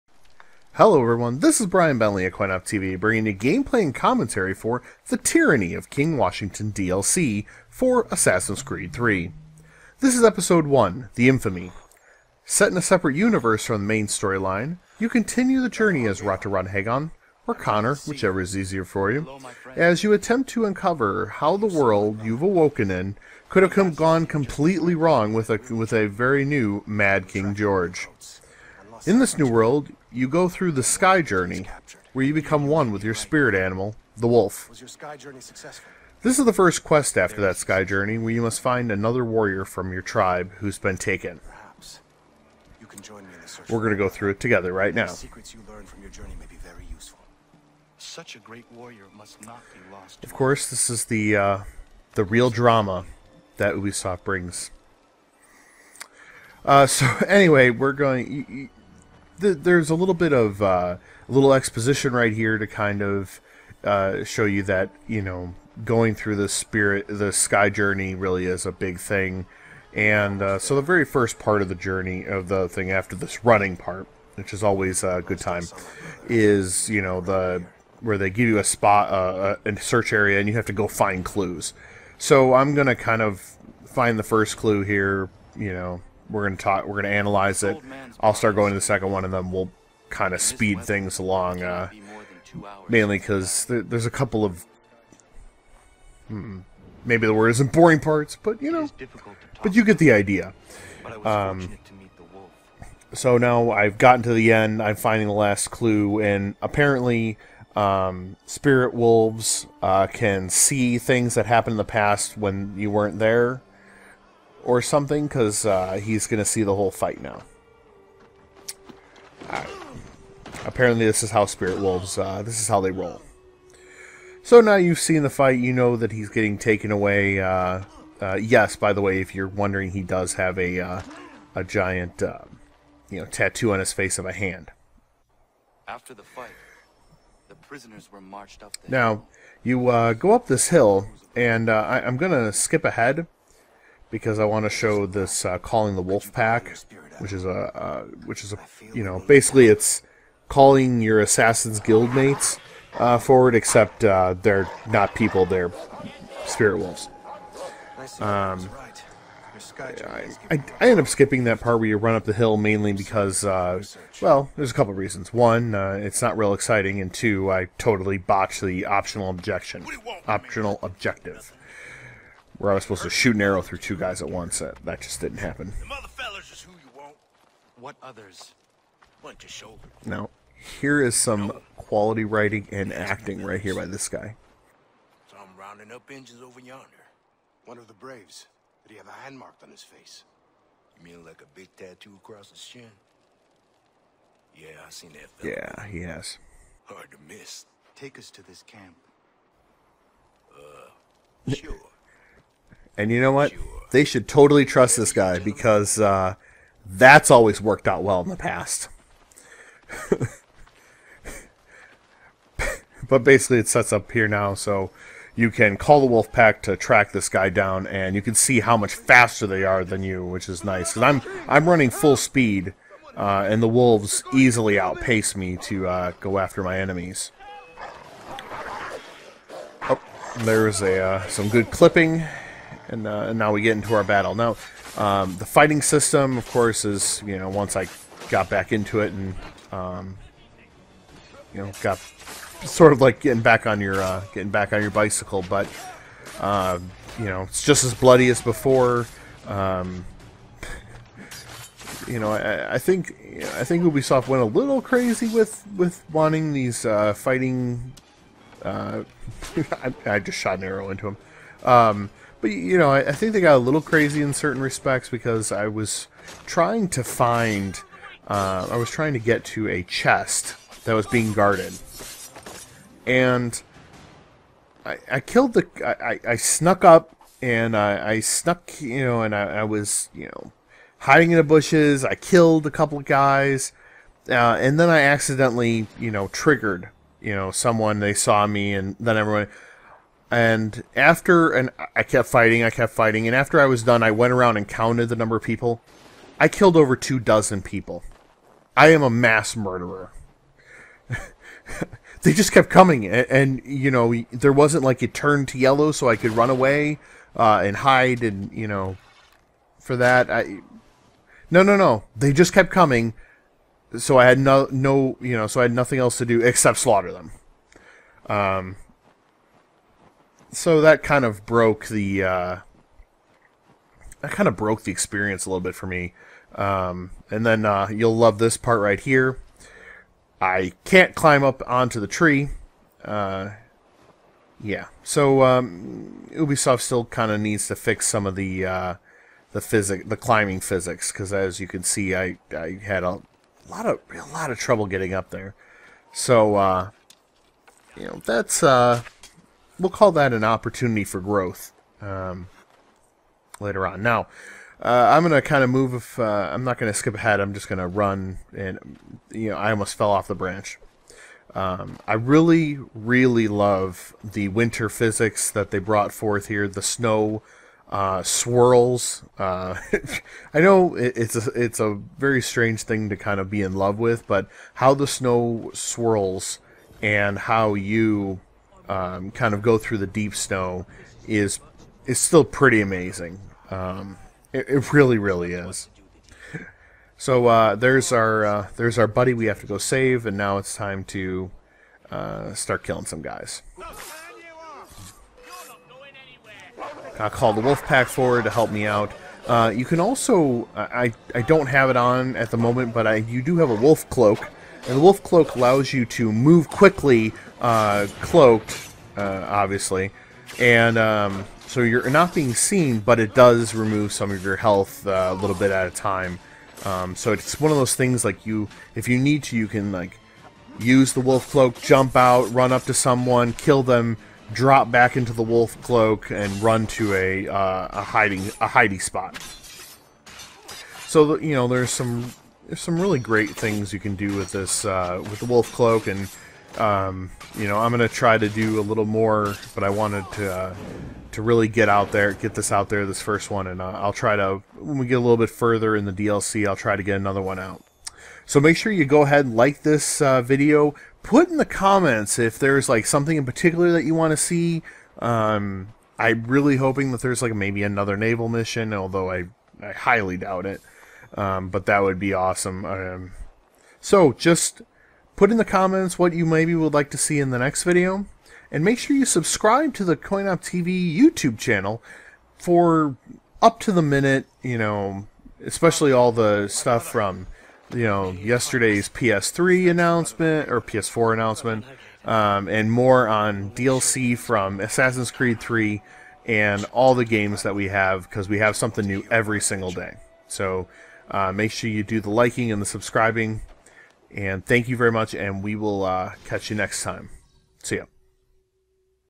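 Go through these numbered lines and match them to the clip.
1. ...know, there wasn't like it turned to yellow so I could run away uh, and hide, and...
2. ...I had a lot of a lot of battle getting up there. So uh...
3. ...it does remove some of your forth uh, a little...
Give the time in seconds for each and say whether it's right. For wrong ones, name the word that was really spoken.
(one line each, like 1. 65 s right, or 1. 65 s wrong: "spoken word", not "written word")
1. 303 s right
2. 342 s wrong: "trouble", not "battle"
3. 413 s wrong: "health", not "forth".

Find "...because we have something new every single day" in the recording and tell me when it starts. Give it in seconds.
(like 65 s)
488 s.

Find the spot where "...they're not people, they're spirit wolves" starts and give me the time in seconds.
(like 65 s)
154 s.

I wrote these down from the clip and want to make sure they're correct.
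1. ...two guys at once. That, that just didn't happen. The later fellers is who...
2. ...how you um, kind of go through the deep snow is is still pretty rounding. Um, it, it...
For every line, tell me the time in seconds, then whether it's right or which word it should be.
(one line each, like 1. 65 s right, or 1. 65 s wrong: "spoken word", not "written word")
1. 173 s wrong: "mother", not "later"
2. 377 s wrong: "amazing", not "rounding".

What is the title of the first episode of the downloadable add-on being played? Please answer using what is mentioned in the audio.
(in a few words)
The Infamy.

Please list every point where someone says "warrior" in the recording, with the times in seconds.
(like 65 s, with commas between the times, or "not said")
39 s, 48 s.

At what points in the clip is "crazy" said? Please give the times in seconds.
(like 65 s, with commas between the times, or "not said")
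254 s, 263 s.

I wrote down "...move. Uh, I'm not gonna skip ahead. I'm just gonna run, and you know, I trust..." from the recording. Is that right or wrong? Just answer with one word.
wrong.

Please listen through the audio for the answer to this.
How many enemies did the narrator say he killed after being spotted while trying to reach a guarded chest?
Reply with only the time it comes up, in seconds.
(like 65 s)
296 s.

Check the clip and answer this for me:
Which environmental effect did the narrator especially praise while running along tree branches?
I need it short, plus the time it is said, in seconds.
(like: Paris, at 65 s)
Winter physics, at 364 s.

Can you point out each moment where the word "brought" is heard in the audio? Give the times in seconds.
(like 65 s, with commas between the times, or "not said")
365 s.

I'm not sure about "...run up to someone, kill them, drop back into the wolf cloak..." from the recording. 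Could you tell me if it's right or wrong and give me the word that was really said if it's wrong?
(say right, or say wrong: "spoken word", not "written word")
right.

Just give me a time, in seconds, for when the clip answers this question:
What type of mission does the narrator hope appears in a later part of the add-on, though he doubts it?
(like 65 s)
458 s.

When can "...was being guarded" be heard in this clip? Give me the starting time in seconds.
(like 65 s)
270 s.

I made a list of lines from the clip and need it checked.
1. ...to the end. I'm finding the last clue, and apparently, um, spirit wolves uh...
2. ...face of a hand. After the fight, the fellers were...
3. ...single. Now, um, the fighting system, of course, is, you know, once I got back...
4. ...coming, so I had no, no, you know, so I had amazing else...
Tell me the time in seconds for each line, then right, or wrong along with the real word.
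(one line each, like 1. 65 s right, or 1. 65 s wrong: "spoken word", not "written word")
1. 104 s right
2. 133 s wrong: "prisoners", not "fellers"
3. 234 s wrong: "battle", not "single"
4. 312 s wrong: "nothing", not "amazing".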